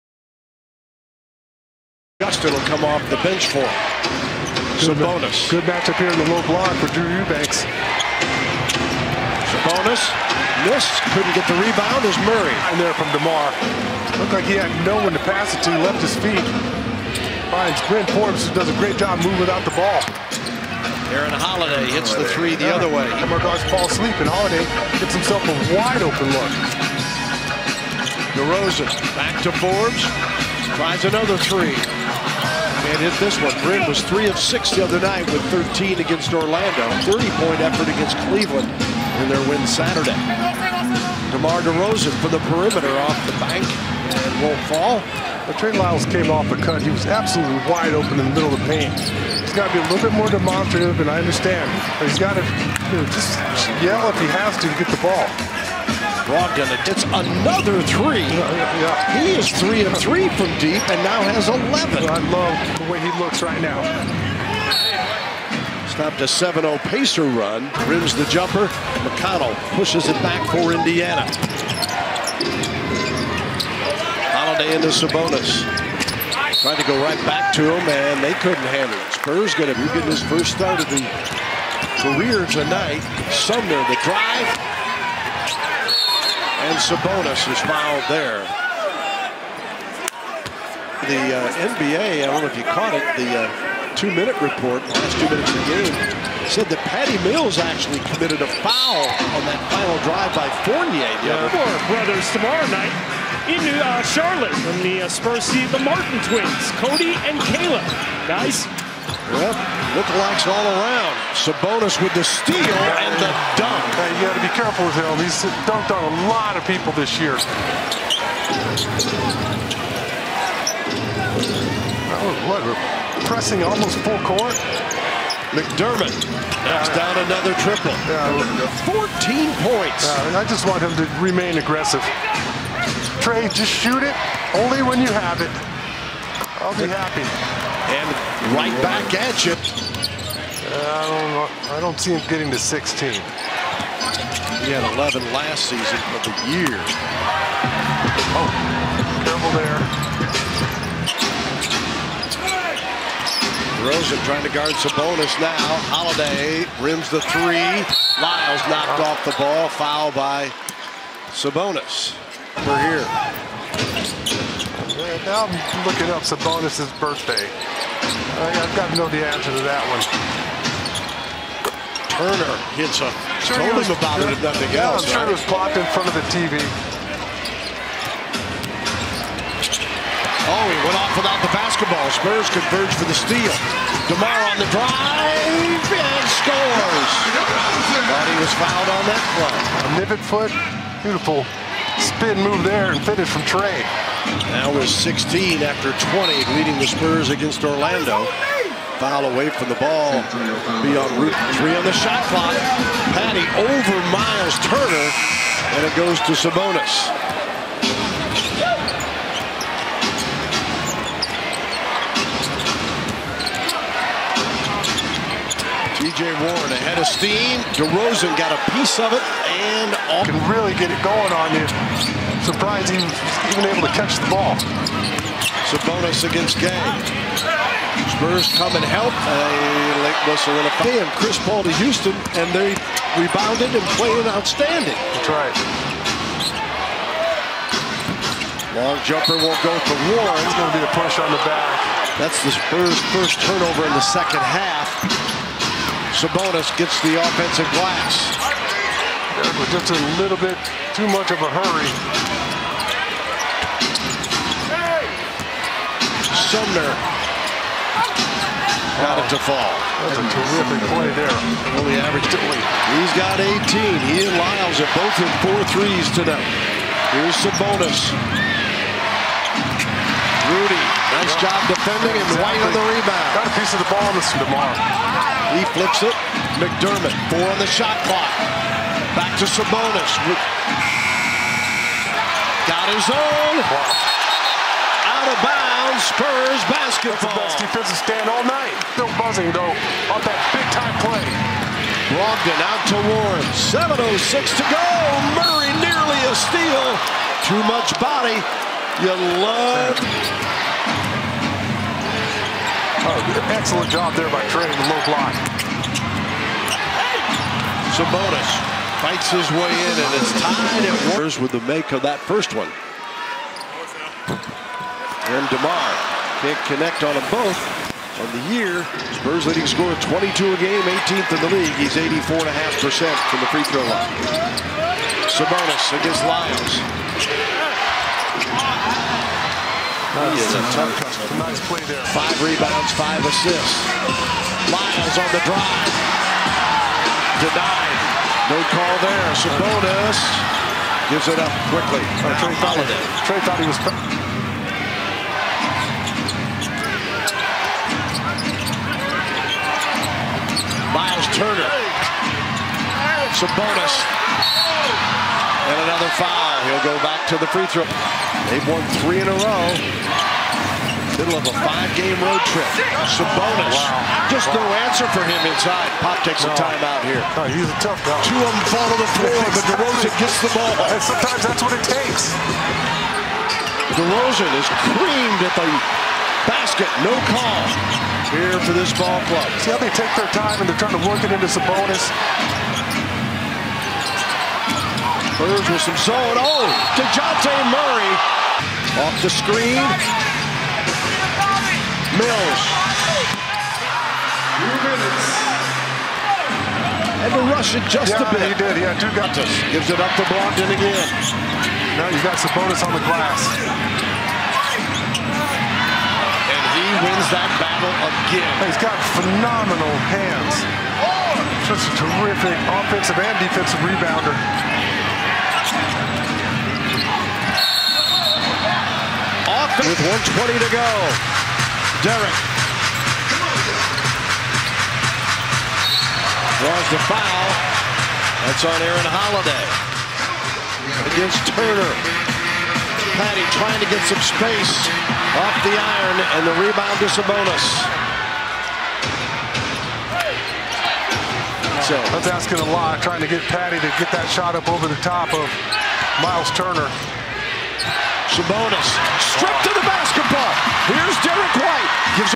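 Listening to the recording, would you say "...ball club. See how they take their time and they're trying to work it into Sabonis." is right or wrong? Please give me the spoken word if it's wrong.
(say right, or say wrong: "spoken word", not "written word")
right.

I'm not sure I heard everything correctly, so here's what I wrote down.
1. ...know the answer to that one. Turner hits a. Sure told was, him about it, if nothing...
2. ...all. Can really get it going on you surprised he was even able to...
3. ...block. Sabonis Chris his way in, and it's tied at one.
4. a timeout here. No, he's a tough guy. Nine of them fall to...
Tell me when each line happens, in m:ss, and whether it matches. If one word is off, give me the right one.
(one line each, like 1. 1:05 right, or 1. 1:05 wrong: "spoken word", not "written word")
1. 2:48 right
2. 3:40 right
3. 5:05 wrong: "Fights", not "Chris"
4. 6:06 wrong: "Two", not "Nine".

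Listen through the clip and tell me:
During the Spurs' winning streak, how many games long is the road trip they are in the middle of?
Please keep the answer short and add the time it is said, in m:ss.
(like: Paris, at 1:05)
5, at 6:01.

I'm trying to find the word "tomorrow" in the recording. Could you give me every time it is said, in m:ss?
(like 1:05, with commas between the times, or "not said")
1:42, 4:34.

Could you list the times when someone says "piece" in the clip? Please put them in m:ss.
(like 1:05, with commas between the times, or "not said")
3:38, 4:33.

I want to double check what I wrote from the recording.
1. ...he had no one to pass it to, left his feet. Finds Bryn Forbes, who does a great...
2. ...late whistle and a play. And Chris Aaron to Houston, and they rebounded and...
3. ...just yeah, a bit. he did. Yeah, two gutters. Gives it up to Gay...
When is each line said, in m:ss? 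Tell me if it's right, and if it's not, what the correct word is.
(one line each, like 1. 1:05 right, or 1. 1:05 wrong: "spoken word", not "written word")
1. 0:14 right
2. 3:50 wrong: "Paul", not "Aaron"
3. 6:37 wrong: "Blondin", not "Gay".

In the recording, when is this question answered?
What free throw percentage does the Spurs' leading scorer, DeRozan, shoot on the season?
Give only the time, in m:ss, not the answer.
5:21.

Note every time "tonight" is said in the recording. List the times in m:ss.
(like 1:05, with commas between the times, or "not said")
1:22, 4:26.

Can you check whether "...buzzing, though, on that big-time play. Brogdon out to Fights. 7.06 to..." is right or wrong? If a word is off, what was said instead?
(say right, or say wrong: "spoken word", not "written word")
wrong: "Warren", not "Fights".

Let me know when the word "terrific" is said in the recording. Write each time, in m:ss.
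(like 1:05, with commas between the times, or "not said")
4:20, 6:52.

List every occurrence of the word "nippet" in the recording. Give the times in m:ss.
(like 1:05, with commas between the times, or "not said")
3:10.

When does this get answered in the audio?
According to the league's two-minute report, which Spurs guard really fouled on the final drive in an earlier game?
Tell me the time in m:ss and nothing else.
1:36.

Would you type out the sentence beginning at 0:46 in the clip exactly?
He was absolutely wide open in the middle of the paint.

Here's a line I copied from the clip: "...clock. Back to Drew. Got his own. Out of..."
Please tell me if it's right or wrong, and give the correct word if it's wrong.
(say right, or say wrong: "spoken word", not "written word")
wrong: "Sabonis", not "Drew".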